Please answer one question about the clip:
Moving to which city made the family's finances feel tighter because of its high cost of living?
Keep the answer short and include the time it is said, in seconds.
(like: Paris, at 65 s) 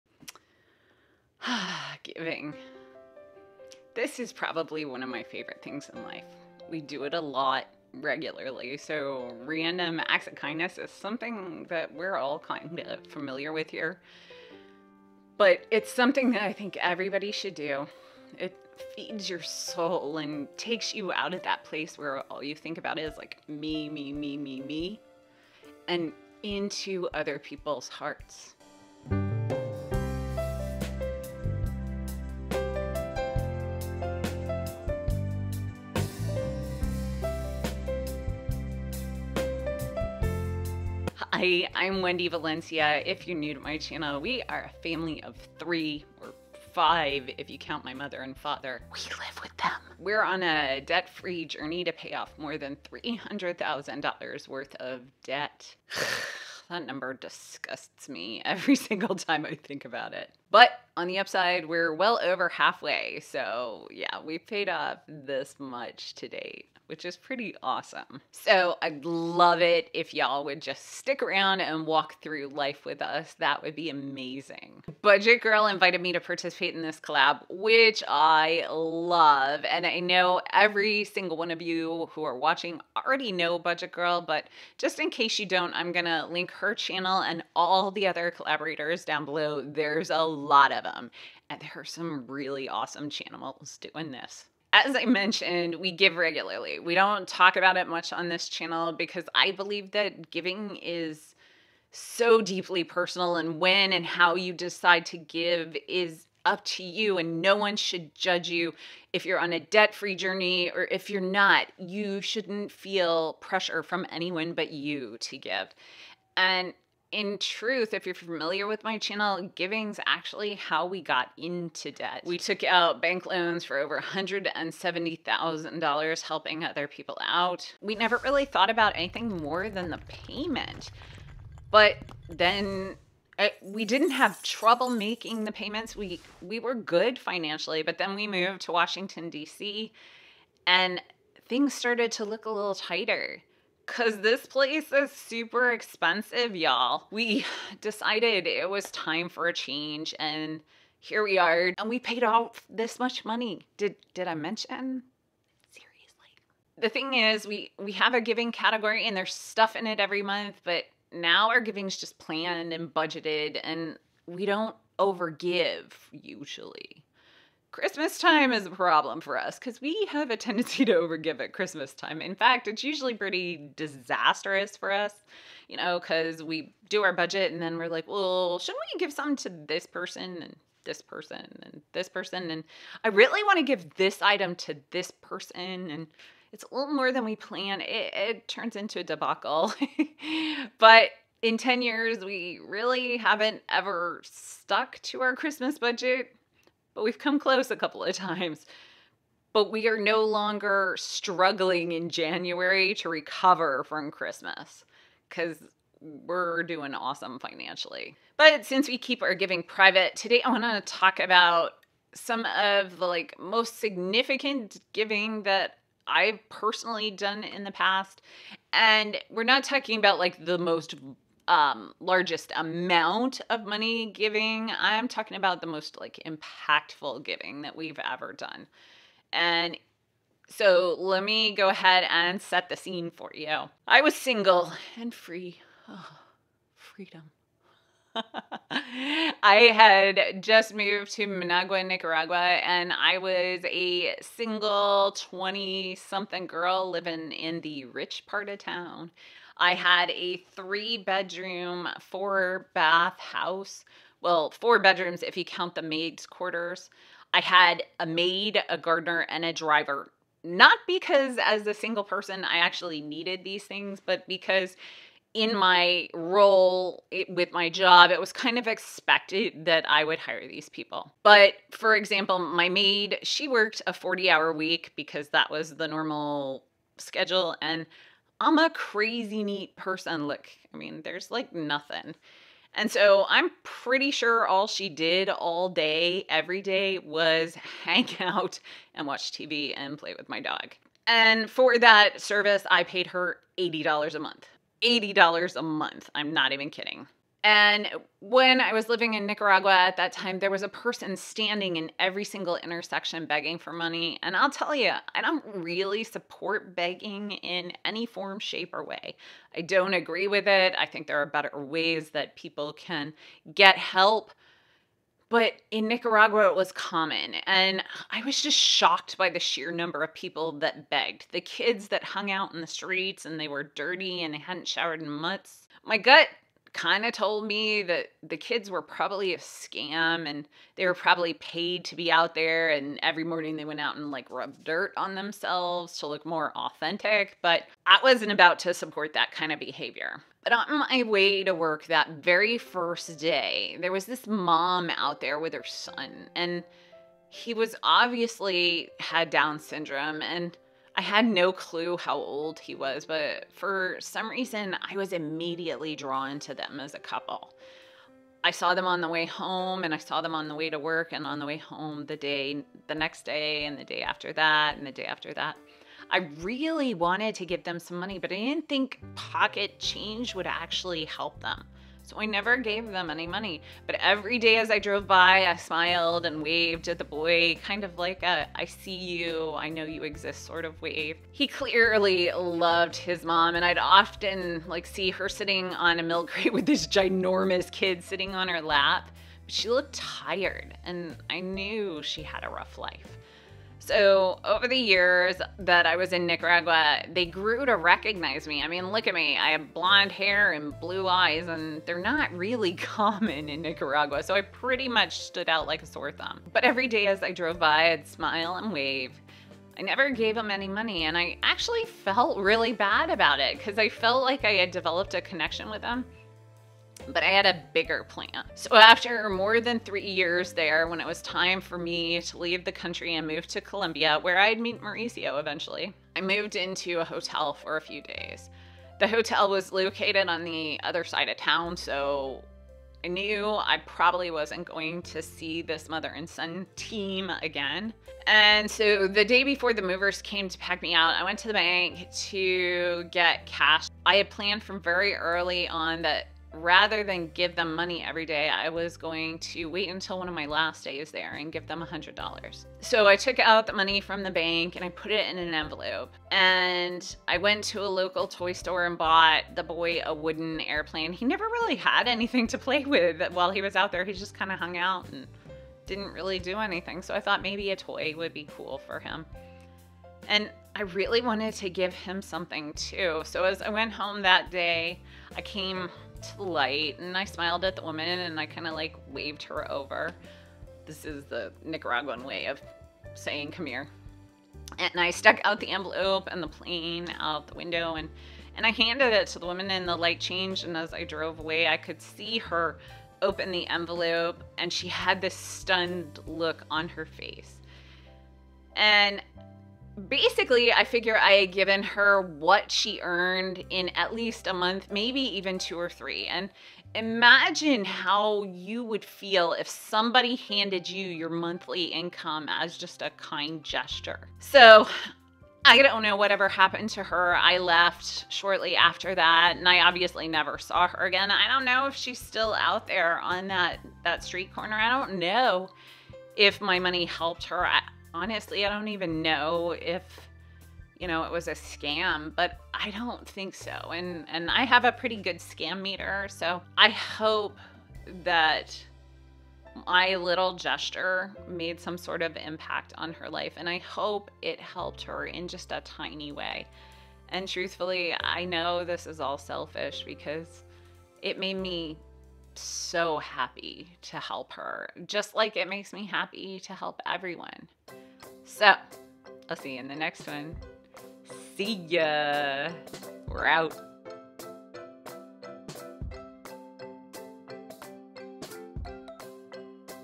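Washington D.C., at 138 s.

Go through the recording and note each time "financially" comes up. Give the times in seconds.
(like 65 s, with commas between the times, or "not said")
137 s, 207 s.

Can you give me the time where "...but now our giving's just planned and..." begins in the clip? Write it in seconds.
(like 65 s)
160 s.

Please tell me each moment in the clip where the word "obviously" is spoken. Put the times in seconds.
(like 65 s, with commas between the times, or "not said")
347 s, 519 s.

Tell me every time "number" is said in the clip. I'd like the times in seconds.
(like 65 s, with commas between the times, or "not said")
56 s, 319 s.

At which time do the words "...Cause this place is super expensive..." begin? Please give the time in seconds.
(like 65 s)
143 s.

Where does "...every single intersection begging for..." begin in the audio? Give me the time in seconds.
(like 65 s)
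301 s.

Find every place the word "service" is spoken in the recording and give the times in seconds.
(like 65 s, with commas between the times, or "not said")
292 s.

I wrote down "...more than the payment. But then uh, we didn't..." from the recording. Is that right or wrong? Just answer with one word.
right.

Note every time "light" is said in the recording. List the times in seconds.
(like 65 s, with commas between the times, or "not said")
476 s, 489 s.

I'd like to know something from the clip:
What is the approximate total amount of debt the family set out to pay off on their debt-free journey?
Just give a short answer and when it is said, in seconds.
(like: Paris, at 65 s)
$300,000, at 52 s.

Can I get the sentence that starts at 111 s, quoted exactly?
You shouldn't feel pressure from anyone but you to give.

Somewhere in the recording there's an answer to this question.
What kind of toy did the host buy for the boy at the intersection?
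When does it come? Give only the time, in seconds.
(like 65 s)
460 s.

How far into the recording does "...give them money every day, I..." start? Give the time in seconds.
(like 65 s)
447 s.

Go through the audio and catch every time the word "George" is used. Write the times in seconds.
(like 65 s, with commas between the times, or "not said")
not said.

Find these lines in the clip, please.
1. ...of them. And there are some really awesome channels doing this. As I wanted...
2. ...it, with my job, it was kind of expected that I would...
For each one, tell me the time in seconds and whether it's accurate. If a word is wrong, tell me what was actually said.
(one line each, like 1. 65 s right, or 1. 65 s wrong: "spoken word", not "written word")
1. 90 s wrong: "mentioned", not "wanted"
2. 267 s right.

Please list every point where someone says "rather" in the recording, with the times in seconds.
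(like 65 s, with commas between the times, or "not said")
446 s.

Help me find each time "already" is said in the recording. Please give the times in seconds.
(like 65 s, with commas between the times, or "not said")
82 s.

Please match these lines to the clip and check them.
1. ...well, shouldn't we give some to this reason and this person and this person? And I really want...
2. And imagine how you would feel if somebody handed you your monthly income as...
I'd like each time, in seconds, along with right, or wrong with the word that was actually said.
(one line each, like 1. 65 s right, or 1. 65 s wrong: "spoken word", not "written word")
1. 178 s wrong: "person", not "reason"
2. 506 s right.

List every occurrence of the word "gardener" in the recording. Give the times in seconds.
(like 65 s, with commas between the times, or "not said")
258 s.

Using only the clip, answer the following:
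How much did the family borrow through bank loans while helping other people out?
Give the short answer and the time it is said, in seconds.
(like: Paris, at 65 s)
$170,000, at 123 s.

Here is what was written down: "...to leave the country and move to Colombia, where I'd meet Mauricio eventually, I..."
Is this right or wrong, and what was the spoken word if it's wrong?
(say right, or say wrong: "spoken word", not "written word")
right.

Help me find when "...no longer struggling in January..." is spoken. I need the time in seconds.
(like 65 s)
199 s.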